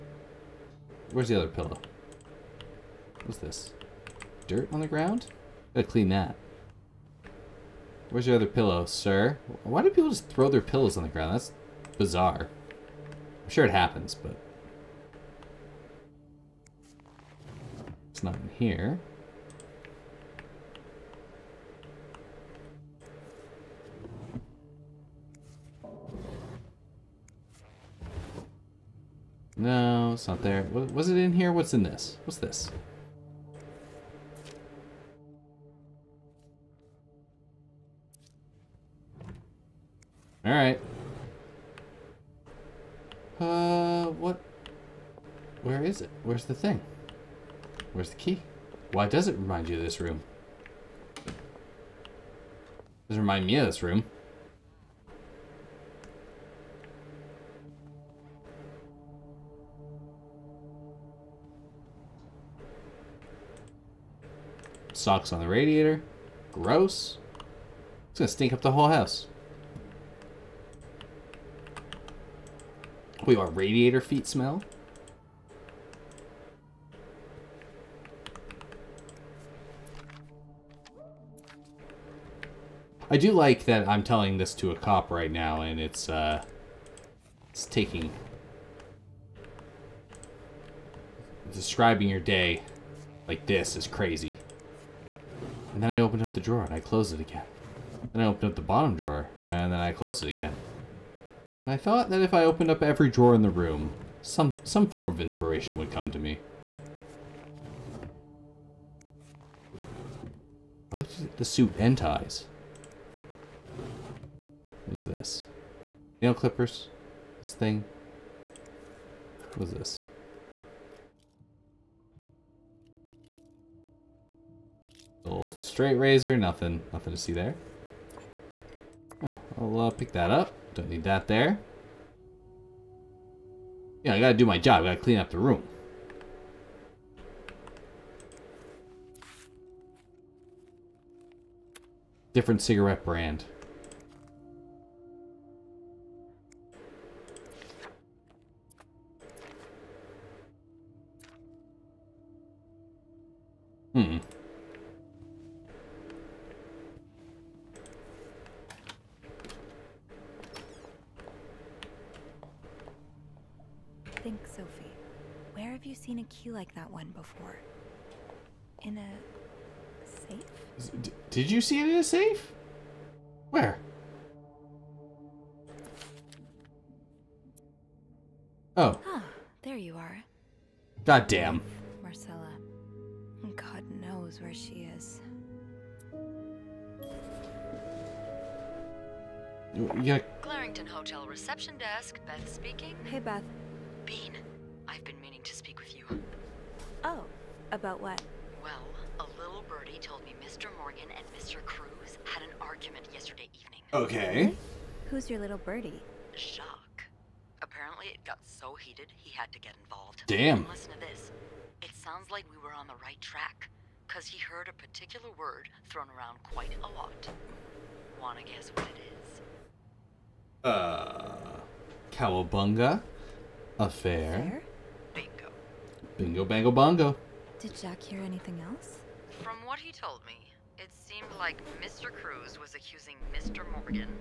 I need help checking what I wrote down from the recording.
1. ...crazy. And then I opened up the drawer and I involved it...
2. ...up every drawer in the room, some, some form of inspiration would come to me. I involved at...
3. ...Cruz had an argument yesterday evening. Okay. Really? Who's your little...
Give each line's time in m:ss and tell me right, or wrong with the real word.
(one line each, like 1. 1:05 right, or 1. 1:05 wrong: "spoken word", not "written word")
1. 1:33 wrong: "closed", not "involved"
2. 1:42 wrong: "looked", not "involved"
3. 3:21 right.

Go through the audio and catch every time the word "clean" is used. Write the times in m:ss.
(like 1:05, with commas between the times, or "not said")
0:05, 2:15.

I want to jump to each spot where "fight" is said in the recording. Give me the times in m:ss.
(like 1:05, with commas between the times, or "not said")
not said.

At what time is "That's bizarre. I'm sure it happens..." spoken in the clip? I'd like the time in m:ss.
0:11.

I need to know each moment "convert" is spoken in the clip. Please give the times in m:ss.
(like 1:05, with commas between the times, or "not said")
not said.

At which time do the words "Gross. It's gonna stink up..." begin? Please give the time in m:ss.
1:06.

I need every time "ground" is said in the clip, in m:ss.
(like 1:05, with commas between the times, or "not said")
0:04, 0:11.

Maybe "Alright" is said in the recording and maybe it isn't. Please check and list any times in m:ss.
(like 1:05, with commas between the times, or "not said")
0:40.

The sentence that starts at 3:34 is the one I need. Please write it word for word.
Because he heard a particular word thrown around quite a lot.